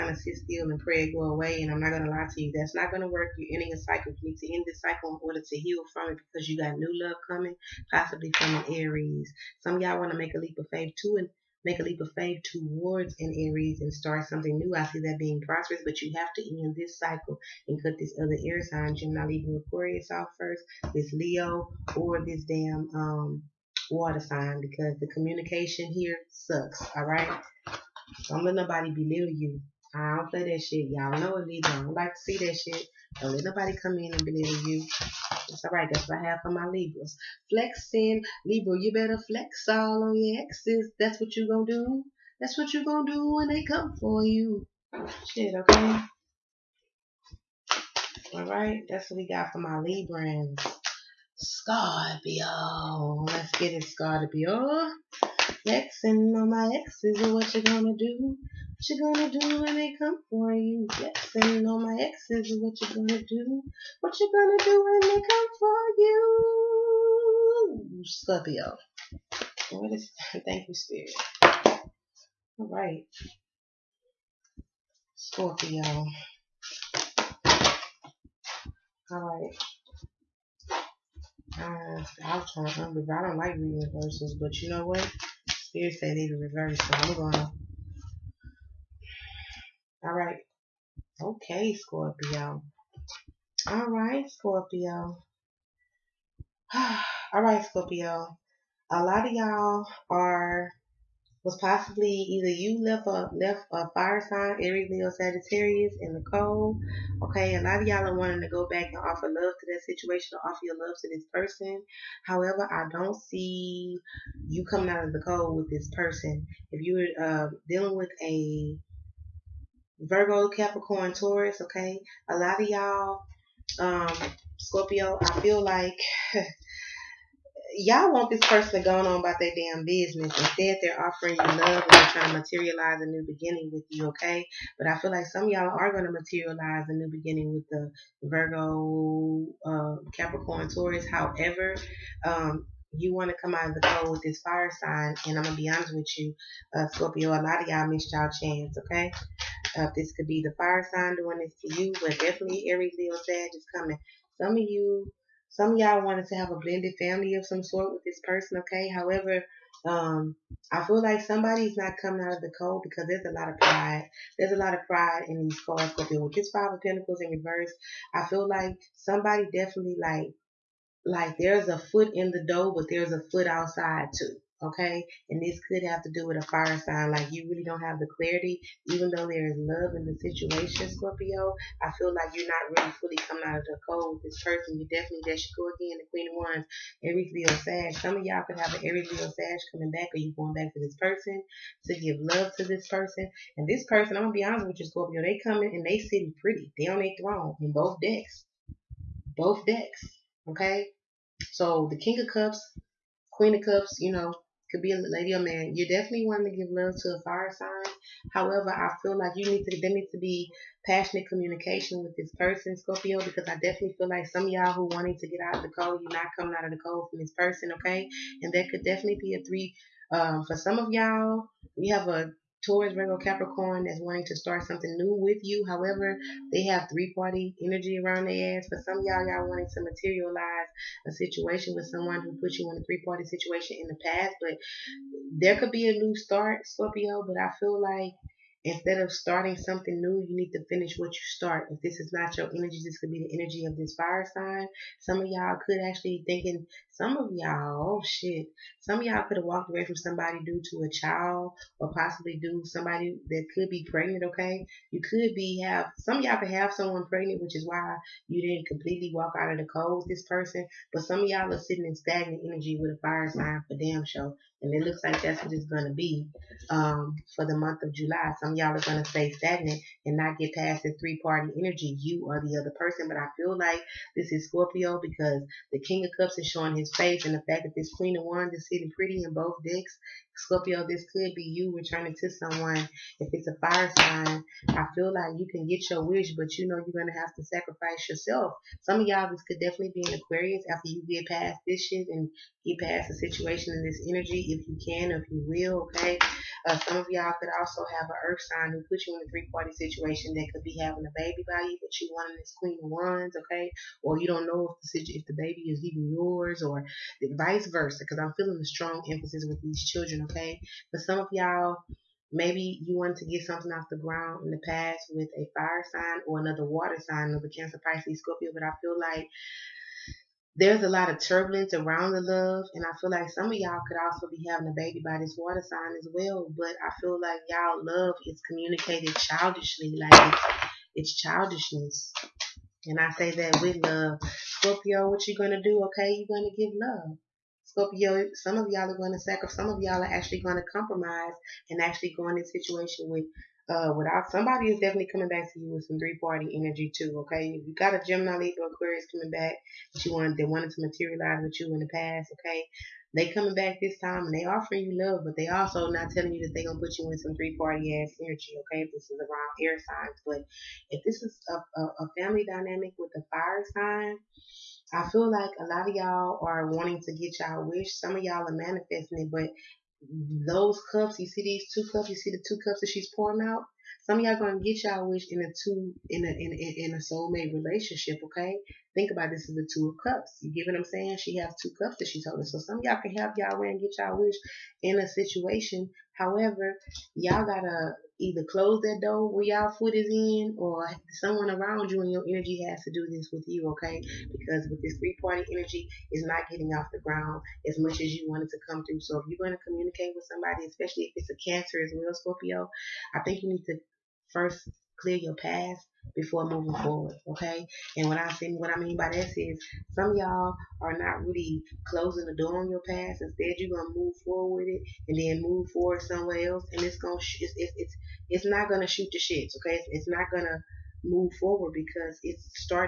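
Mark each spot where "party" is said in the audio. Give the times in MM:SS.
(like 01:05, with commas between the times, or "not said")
03:47, 03:53, 04:31, 04:59, 05:46, 05:57, 06:35.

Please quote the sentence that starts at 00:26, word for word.
All right, don't let nobody belittle you.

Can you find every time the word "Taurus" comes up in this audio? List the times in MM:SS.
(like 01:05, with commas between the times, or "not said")
02:01, 02:20, 03:42.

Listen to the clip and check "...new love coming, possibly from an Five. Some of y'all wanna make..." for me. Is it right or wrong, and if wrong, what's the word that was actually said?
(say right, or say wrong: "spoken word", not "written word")
wrong: "Aries", not "Five".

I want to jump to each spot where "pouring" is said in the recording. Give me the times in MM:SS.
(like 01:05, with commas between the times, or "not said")
06:13.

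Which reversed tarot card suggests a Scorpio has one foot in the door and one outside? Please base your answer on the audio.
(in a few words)
Five of Pentacles.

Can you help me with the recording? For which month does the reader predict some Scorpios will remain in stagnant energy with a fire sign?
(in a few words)
July.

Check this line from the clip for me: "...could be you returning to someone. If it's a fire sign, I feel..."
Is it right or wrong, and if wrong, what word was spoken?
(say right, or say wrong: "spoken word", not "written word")
right.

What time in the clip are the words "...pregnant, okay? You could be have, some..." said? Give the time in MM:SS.
04:13.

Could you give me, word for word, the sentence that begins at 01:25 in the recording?
Spirit said need to reverse, so I'm gonna.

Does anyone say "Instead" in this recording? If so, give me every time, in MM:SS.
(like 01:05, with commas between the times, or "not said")
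02:10, 03:58, 06:53.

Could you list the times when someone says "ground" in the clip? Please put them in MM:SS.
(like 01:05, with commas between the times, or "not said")
05:13, 06:36.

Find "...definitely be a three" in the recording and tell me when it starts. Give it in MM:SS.
03:38.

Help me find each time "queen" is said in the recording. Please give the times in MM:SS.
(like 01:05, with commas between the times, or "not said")
03:06, 03:23, 04:37, 05:02.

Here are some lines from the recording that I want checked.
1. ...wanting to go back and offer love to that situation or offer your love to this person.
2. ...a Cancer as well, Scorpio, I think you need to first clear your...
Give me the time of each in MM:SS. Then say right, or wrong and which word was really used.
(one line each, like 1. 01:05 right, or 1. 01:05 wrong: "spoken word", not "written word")
1. 01:48 right
2. 06:41 right.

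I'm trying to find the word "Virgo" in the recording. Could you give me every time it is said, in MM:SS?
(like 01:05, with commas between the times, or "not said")
02:00, 02:18, 03:42.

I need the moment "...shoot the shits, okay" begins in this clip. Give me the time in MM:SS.
06:58.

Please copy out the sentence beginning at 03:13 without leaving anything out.
And this person, I'm gonna be honest with you, Scorpio.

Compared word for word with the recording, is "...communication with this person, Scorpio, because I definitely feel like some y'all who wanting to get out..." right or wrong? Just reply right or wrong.
right.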